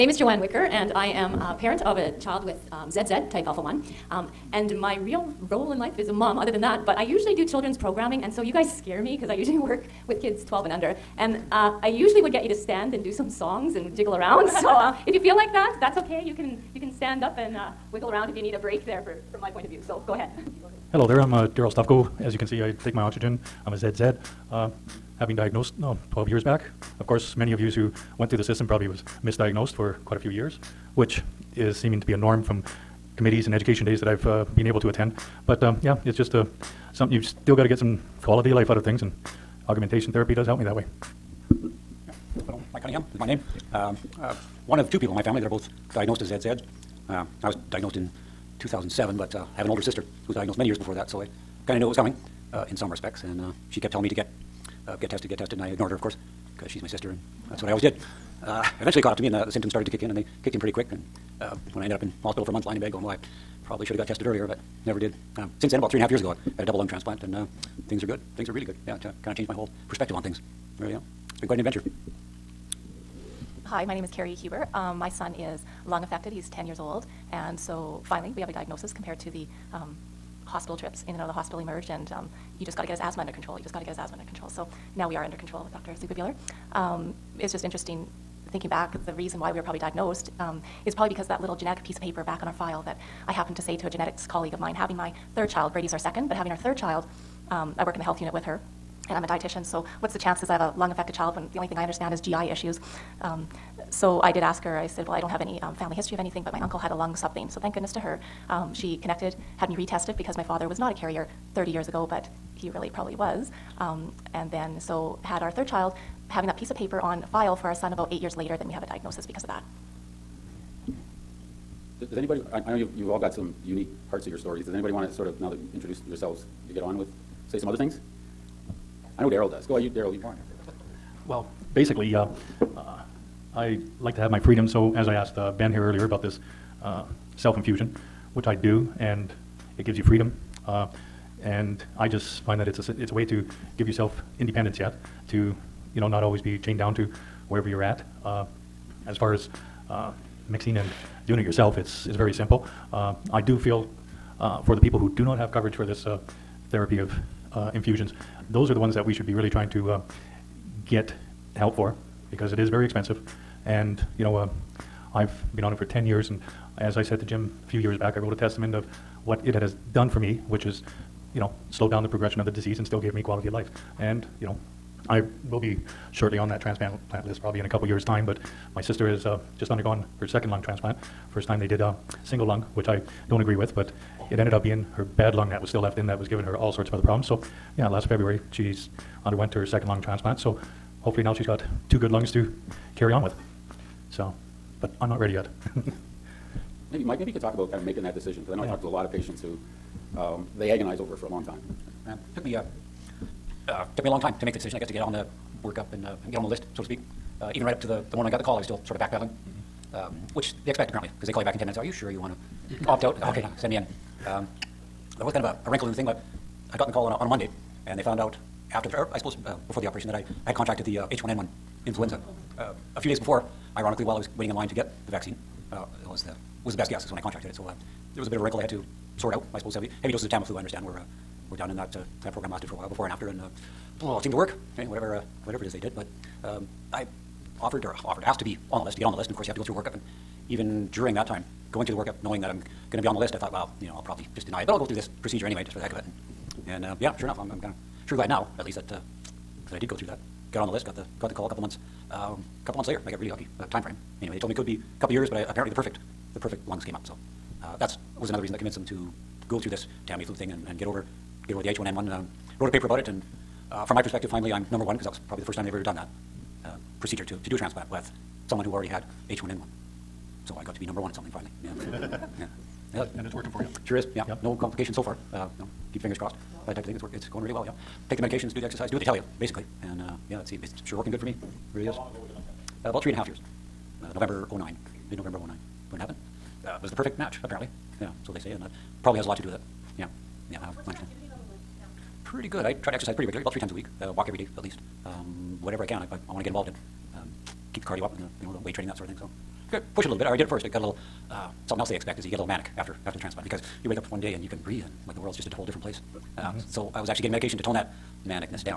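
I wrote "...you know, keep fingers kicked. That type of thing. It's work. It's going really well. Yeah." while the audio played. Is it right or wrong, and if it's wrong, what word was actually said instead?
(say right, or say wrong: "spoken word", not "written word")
wrong: "crossed", not "kicked".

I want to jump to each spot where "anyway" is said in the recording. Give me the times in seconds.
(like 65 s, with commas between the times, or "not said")
245 s, 254 s.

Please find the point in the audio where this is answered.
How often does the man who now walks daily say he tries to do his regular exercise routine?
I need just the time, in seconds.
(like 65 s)
293 s.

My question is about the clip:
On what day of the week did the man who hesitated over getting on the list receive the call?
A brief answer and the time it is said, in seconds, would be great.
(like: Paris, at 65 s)
Monday, at 217 s.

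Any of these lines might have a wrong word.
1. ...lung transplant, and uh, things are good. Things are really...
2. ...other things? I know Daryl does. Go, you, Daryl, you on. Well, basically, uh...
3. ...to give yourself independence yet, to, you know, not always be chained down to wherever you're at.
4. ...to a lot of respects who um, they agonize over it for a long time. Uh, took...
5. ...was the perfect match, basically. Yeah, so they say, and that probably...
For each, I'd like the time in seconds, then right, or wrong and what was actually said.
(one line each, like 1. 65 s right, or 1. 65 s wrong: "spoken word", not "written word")
1. 66 s right
2. 127 s right
3. 143 s right
4. 198 s wrong: "patients", not "respects"
5. 286 s wrong: "apparently", not "basically".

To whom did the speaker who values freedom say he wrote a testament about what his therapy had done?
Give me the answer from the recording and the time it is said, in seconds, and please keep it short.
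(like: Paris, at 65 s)
Jim, at 167 s.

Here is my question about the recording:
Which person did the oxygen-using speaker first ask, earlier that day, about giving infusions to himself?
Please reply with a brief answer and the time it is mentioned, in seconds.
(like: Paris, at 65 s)
Ben, at 135 s.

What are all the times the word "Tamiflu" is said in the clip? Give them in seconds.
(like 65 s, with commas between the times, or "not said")
230 s, 260 s.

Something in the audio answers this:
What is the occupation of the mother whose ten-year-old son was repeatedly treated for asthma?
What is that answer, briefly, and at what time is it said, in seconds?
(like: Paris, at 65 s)
Dietitian, at 99 s.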